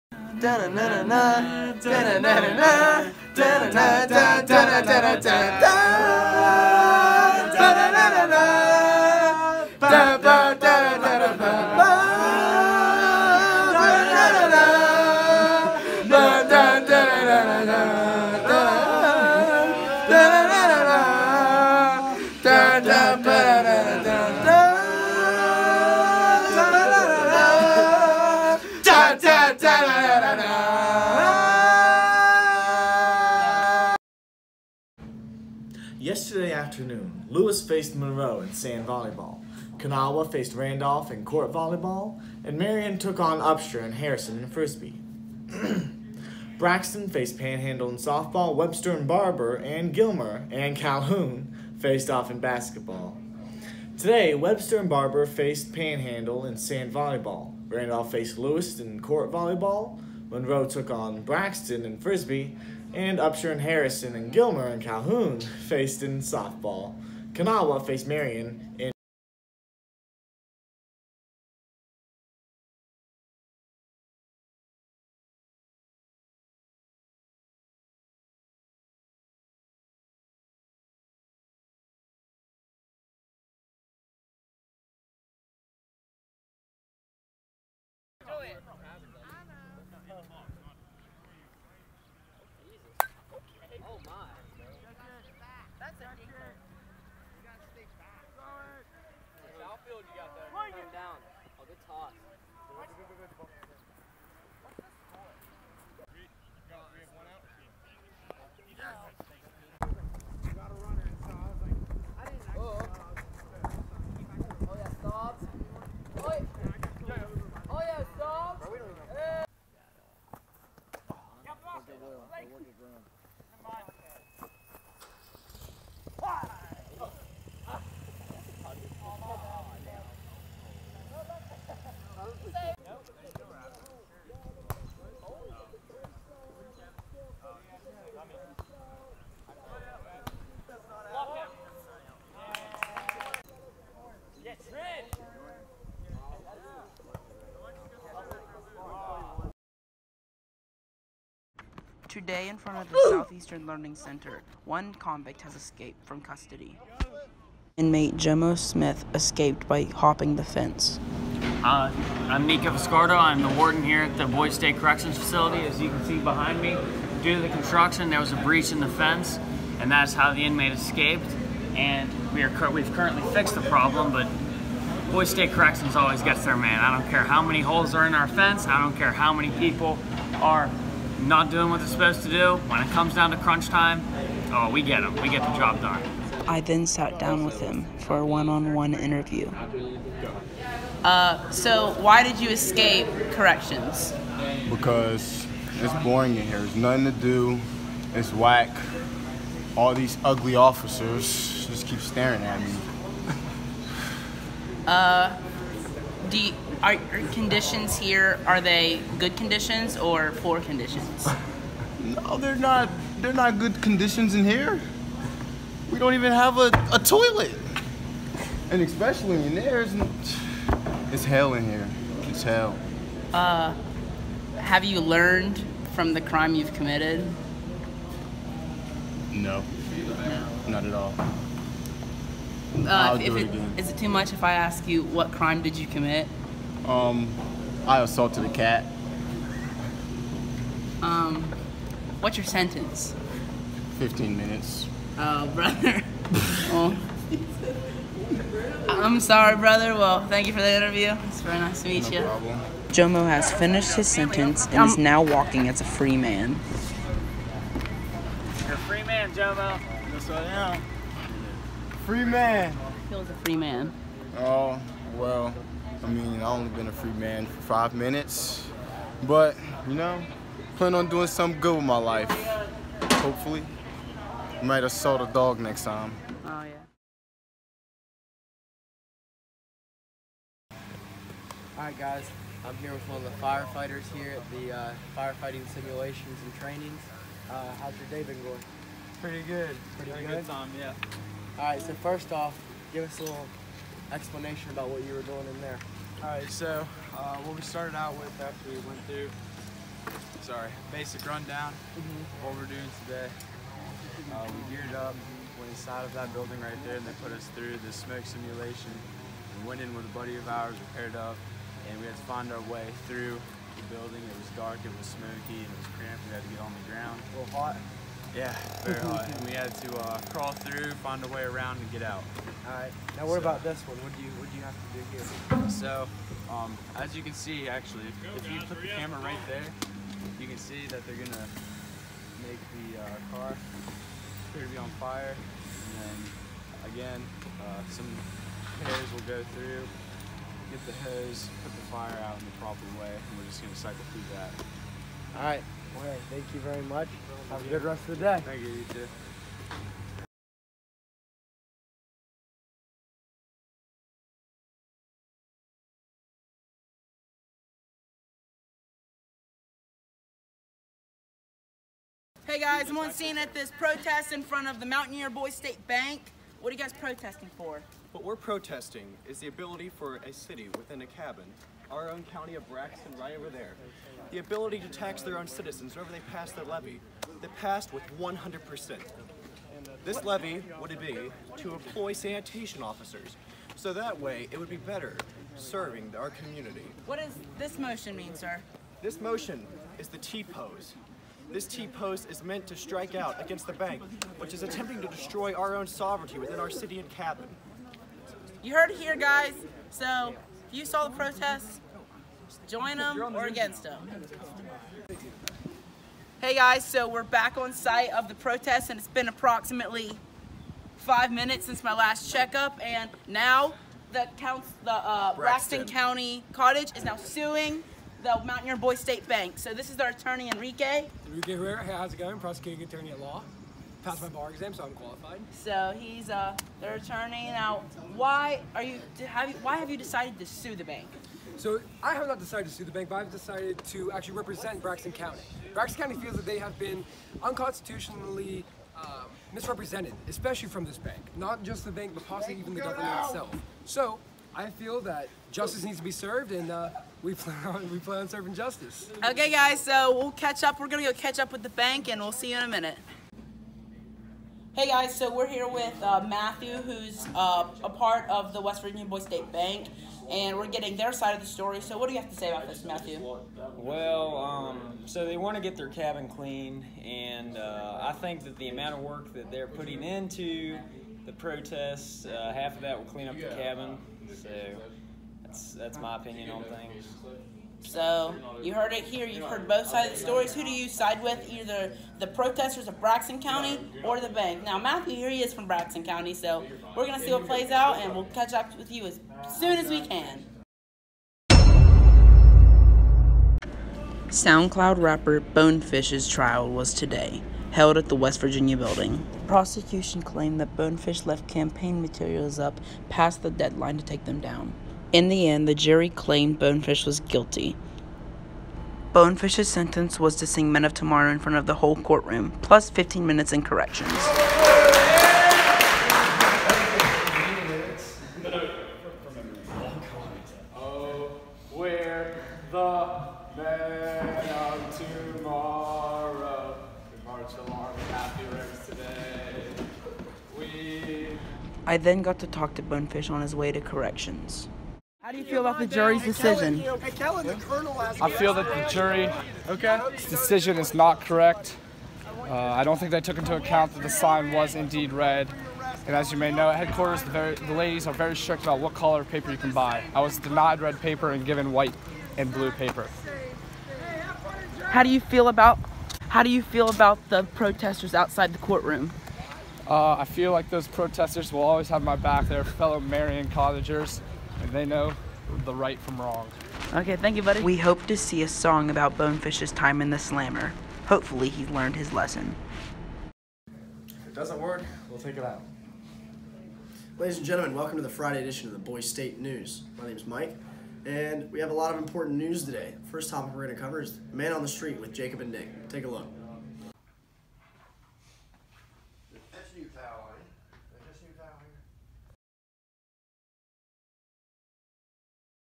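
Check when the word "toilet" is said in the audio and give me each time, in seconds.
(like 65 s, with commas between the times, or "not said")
216 s.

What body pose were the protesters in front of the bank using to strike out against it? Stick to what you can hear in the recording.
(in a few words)
T-pose.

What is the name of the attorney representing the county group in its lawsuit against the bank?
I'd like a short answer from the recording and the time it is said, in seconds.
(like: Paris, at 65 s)
Enrique Herrera, at 421 s.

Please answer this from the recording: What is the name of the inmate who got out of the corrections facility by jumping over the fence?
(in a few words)
Jomo Smith.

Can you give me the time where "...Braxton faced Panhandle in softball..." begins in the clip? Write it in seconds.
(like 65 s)
46 s.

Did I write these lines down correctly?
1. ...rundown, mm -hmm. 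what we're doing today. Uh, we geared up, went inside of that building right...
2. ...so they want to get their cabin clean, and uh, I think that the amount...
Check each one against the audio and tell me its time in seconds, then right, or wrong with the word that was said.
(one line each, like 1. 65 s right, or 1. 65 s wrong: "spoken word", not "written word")
1. 301 s right
2. 465 s right.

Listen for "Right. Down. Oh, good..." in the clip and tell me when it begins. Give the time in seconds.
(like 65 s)
100 s.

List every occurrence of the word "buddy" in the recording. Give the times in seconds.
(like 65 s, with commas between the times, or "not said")
310 s, 567 s.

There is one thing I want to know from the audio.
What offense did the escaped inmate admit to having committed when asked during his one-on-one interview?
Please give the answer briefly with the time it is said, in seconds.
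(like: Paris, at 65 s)
Assaulted a cat, at 237 s.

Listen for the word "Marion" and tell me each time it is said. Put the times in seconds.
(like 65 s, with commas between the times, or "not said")
42 s, 68 s, 563 s.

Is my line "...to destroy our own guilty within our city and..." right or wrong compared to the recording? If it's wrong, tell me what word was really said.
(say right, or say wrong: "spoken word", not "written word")
wrong: "sovereignty", not "guilty".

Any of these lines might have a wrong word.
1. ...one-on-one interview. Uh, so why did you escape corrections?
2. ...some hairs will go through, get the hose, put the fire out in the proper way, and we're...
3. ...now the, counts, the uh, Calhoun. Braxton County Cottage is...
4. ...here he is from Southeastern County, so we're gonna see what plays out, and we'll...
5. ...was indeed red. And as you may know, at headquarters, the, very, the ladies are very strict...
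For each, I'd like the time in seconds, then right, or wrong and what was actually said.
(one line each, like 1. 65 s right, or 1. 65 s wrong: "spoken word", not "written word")
1. 188 s right
2. 337 s right
3. 413 s wrong: "Braxton", not "Calhoun"
4. 485 s wrong: "Braxton", not "Southeastern"
5. 544 s right.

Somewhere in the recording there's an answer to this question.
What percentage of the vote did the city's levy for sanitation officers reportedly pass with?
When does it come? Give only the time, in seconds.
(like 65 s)
378 s.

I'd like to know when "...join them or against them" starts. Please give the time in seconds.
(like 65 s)
402 s.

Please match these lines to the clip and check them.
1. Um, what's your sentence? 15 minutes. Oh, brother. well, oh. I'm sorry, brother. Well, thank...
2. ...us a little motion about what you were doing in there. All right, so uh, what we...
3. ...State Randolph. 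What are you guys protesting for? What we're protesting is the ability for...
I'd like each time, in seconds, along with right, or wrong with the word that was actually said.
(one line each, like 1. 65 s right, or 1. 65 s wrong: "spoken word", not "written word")
1. 241 s right
2. 293 s wrong: "explanation", not "motion"
3. 365 s wrong: "Bank", not "Randolph".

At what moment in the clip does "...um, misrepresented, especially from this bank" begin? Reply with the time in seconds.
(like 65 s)
438 s.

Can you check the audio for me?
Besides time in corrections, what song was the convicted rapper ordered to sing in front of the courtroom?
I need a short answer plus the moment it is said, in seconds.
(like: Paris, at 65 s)
Men of Tomorrow, at 510 s.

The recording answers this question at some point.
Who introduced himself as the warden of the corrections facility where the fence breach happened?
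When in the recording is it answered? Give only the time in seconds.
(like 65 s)
162 s.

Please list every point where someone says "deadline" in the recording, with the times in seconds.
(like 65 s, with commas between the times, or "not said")
503 s.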